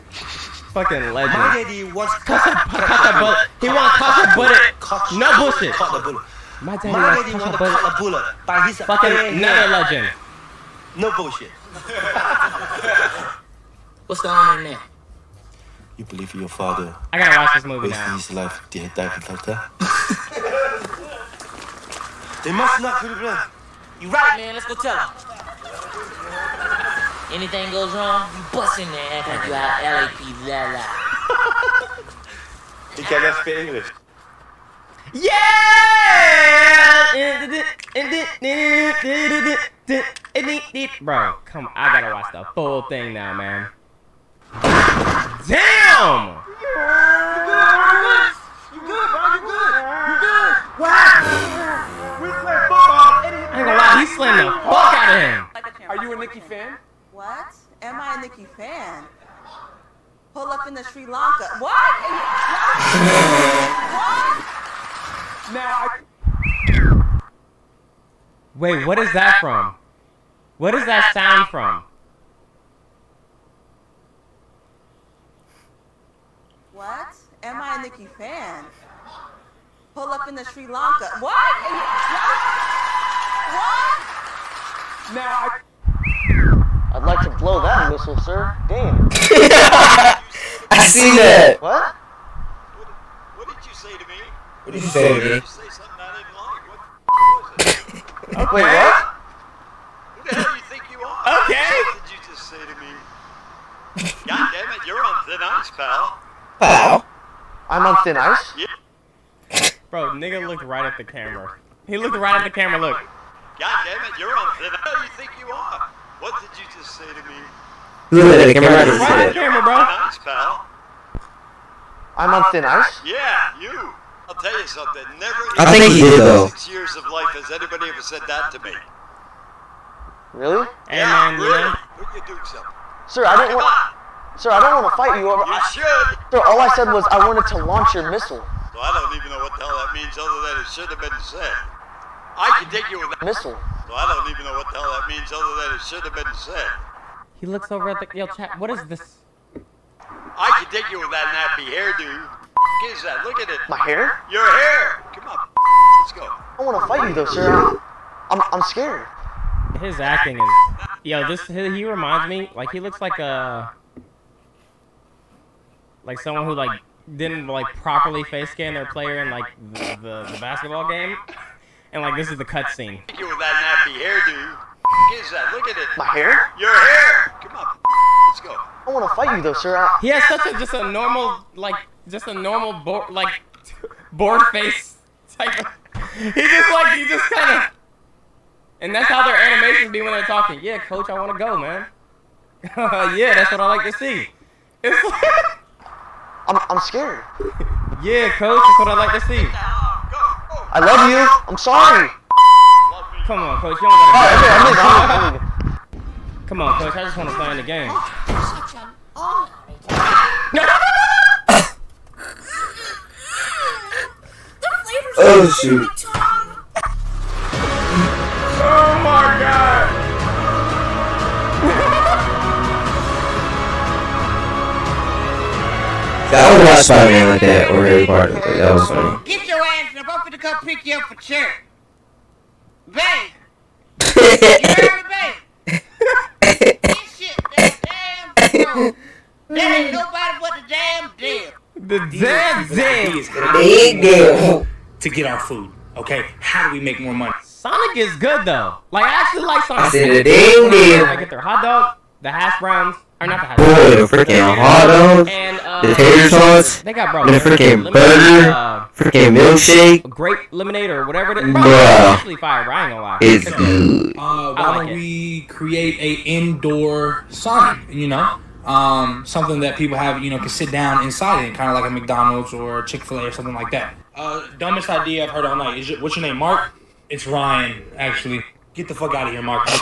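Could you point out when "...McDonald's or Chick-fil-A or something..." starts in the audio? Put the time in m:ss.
4:31.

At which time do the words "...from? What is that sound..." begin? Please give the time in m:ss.
1:09.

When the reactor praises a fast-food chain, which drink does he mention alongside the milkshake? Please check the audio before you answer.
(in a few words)
Grape lemonade.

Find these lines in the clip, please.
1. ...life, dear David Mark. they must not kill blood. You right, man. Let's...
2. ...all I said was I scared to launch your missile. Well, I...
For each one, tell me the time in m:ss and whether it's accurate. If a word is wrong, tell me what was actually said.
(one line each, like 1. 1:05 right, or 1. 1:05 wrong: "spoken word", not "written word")
1. 0:18 wrong: "Luther", not "Mark"
2. 2:16 wrong: "wanted", not "scared".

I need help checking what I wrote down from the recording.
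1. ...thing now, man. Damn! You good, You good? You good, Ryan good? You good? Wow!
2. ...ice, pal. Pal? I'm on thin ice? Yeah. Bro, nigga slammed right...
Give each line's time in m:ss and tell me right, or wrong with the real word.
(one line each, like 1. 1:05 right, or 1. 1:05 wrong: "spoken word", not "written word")
1. 0:42 wrong: "You", not "Ryan"
2. 1:45 wrong: "looked", not "slammed".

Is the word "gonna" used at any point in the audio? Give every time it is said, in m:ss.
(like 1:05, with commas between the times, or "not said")
4:22.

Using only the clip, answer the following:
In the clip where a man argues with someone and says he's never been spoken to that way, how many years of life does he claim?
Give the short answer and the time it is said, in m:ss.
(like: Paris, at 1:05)
6, at 2:06.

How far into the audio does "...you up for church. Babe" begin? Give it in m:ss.
3:50.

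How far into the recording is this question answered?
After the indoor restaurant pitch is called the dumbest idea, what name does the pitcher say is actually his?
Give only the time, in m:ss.
4:37.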